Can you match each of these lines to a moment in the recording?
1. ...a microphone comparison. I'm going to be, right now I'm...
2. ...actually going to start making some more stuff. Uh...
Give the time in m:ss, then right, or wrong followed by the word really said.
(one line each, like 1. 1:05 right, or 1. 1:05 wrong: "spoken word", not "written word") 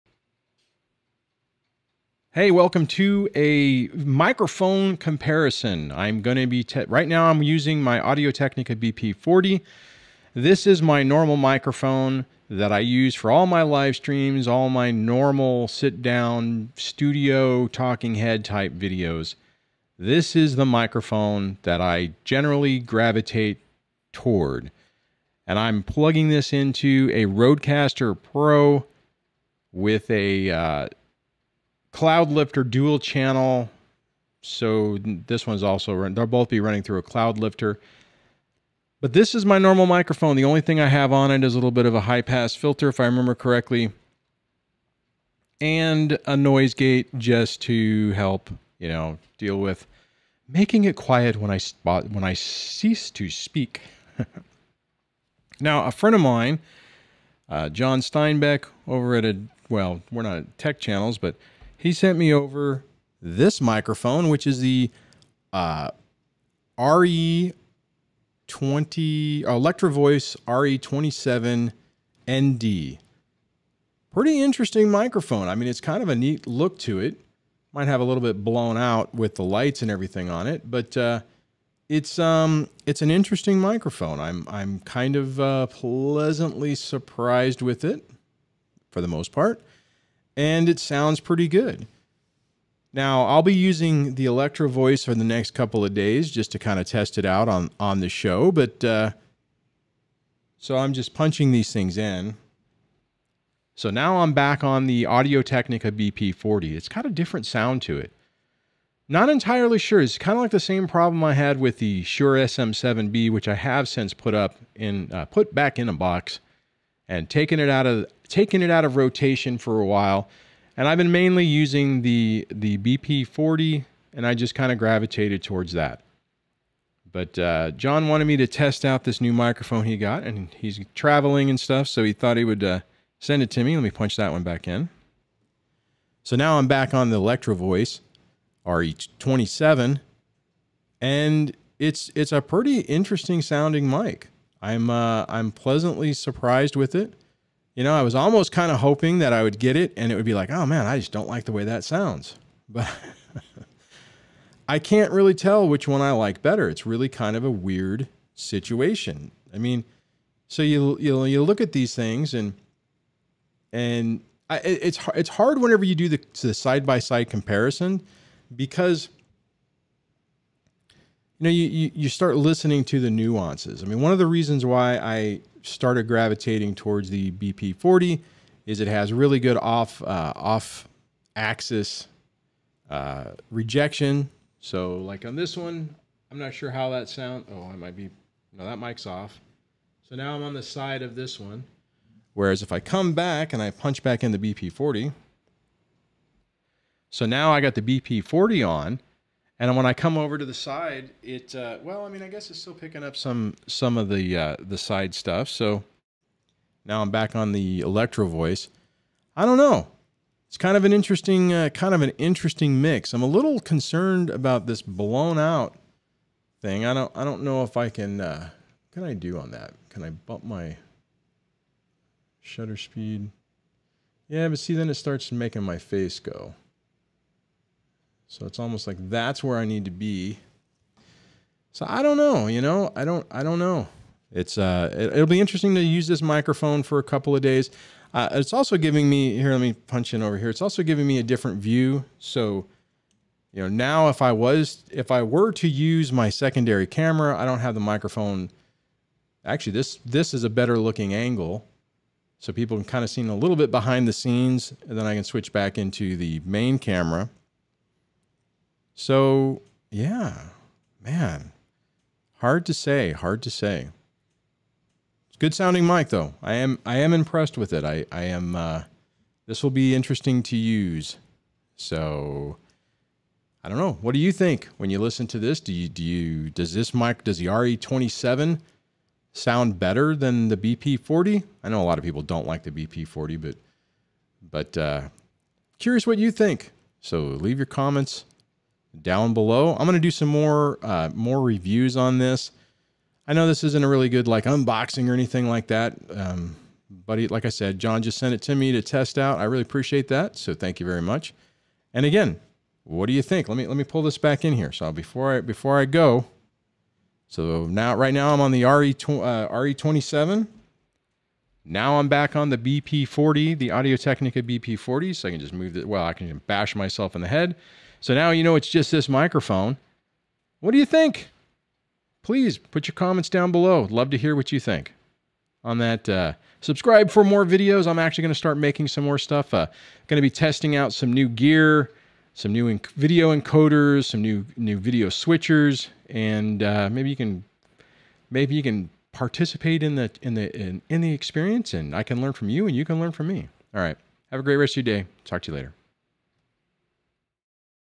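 1. 0:03 right
2. 5:27 right.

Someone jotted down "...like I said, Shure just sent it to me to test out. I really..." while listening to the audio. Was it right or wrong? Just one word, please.
wrong.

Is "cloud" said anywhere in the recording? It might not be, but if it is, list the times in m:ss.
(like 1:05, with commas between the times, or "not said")
0:31, 0:37.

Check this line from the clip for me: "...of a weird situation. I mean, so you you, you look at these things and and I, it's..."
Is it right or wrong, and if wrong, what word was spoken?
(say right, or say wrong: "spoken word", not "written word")
right.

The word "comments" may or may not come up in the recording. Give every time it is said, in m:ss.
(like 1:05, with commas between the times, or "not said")
4:47, 5:22.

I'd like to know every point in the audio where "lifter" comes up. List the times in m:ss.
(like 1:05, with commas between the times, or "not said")
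0:32, 0:37.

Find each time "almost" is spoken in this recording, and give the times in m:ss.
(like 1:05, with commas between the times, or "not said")
2:28, 3:48.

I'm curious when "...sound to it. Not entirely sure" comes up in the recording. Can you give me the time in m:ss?
1:47.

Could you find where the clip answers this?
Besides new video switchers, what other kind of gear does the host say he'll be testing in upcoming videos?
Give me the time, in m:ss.
5:32.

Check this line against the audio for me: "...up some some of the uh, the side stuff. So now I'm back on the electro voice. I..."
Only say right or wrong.
right.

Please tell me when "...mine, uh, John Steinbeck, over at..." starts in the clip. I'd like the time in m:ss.
0:56.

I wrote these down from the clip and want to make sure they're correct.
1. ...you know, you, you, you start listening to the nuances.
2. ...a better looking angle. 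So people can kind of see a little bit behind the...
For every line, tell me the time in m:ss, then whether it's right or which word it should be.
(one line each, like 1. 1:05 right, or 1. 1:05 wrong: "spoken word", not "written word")
1. 2:51 right
2. 4:10 right.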